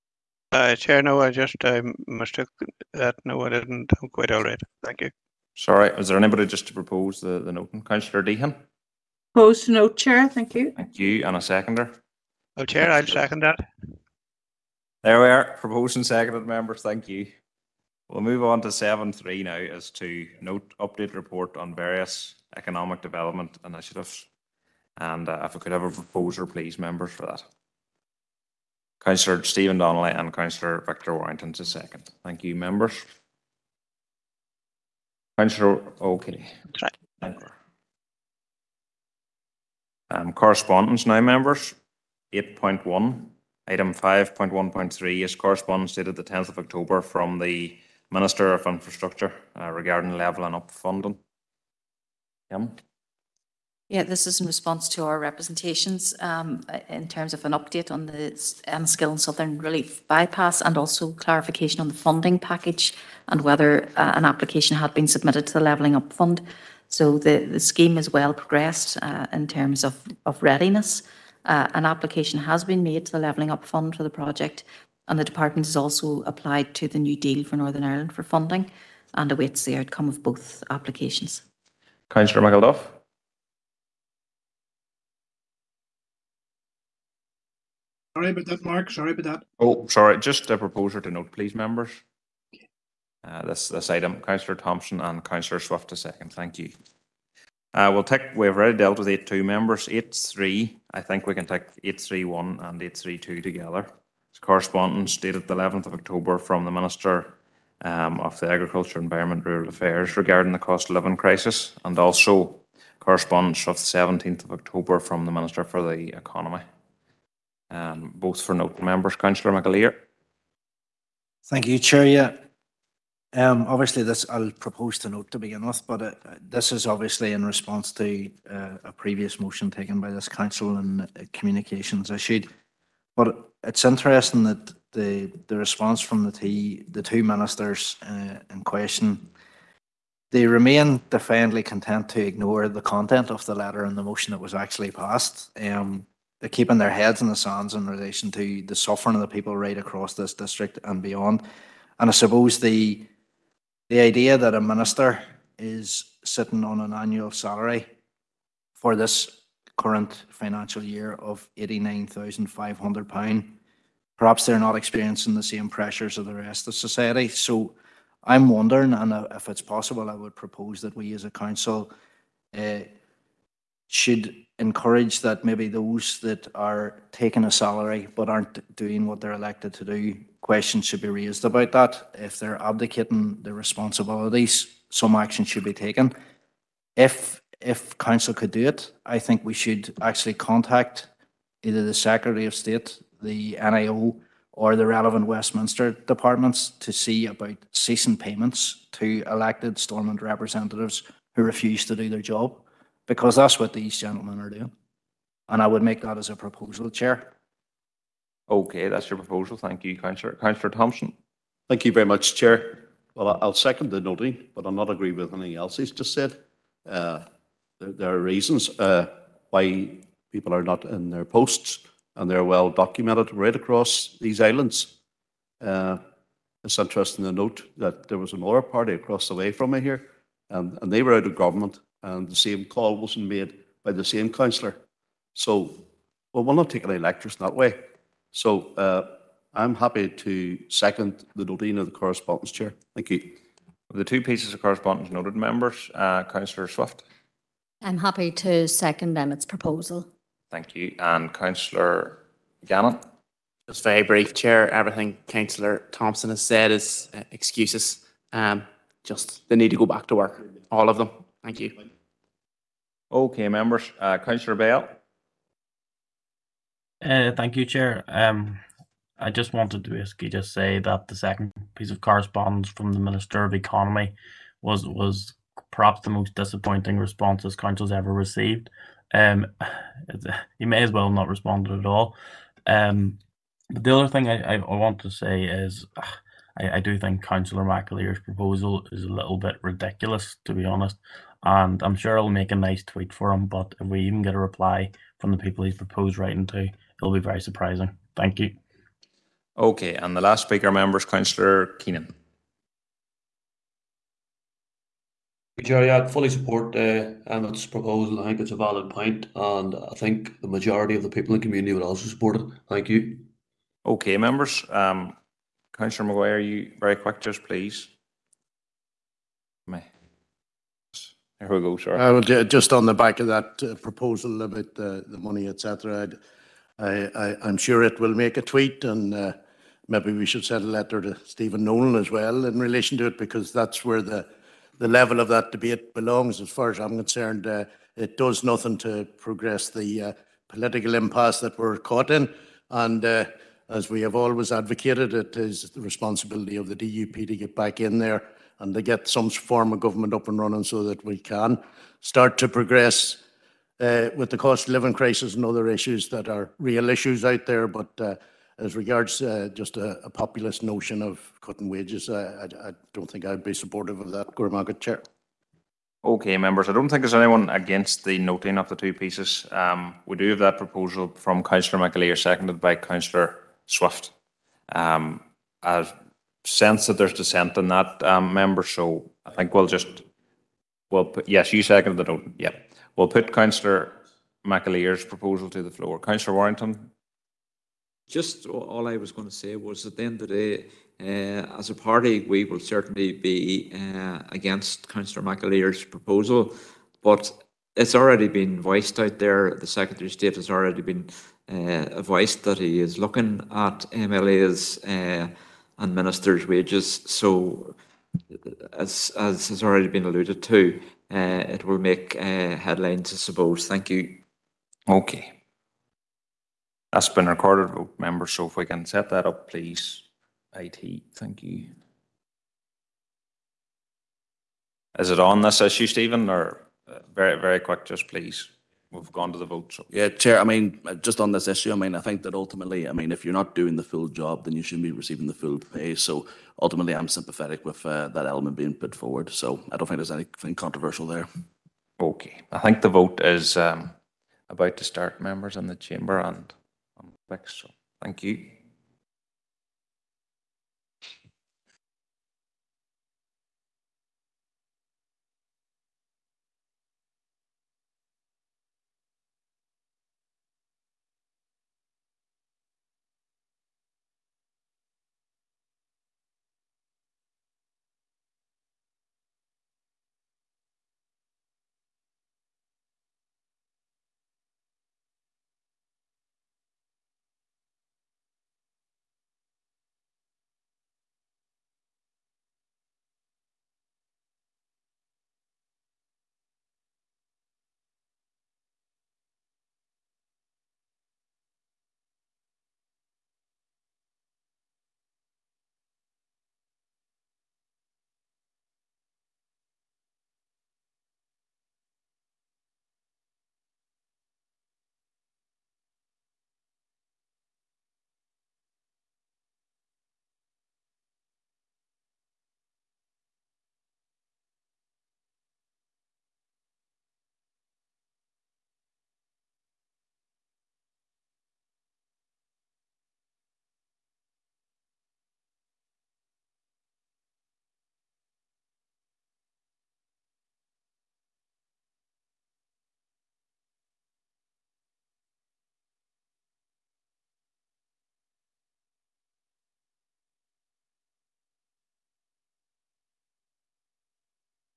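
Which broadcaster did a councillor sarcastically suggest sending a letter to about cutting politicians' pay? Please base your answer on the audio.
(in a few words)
Stephen Nolan.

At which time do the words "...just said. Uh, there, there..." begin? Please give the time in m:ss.
3:35.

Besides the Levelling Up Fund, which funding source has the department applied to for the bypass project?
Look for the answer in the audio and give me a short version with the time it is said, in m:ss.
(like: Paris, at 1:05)
New Deal for Northern Ireland, at 1:16.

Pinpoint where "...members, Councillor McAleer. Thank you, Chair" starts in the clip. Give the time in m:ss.
1:58.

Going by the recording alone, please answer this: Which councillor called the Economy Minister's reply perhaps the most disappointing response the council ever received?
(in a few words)
Councillor Bell.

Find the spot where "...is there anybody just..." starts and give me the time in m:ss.
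0:05.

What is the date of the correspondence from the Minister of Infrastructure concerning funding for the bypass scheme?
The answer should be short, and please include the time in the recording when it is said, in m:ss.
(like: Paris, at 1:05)
10th of October, at 0:46.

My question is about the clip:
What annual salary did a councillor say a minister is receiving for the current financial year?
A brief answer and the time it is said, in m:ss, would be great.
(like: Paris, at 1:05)
£89,500, at 2:41.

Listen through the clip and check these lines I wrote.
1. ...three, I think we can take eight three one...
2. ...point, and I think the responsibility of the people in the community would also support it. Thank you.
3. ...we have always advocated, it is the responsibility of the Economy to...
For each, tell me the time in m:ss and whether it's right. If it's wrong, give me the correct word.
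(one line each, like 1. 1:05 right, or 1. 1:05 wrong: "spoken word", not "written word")
1. 1:40 right
2. 5:08 wrong: "majority", not "responsibility"
3. 5:43 wrong: "DUP", not "Economy".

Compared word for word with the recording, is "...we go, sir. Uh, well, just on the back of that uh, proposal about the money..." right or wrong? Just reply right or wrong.
right.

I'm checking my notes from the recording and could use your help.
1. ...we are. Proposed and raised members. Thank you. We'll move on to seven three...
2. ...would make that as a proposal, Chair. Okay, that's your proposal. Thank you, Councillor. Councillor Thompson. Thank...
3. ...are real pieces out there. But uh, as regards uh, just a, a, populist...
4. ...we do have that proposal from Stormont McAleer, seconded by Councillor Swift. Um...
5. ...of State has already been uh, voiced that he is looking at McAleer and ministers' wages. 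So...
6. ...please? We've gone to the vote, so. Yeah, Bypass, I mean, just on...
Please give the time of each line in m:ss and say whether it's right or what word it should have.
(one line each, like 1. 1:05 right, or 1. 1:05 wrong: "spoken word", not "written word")
1. 0:15 wrong: "seconded", not "raised"
2. 3:25 right
3. 5:56 wrong: "issues", not "pieces"
4. 6:10 wrong: "Councillor", not "Stormont"
5. 6:40 wrong: "MLAs", not "McAleer"
6. 7:08 wrong: "Chair", not "Bypass".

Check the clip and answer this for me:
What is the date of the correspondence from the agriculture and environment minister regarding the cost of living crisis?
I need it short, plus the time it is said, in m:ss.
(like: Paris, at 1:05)
11th of October, at 1:45.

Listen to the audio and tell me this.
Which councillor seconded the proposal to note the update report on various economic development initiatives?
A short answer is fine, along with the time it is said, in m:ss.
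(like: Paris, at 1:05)
Victor Warrington, at 0:30.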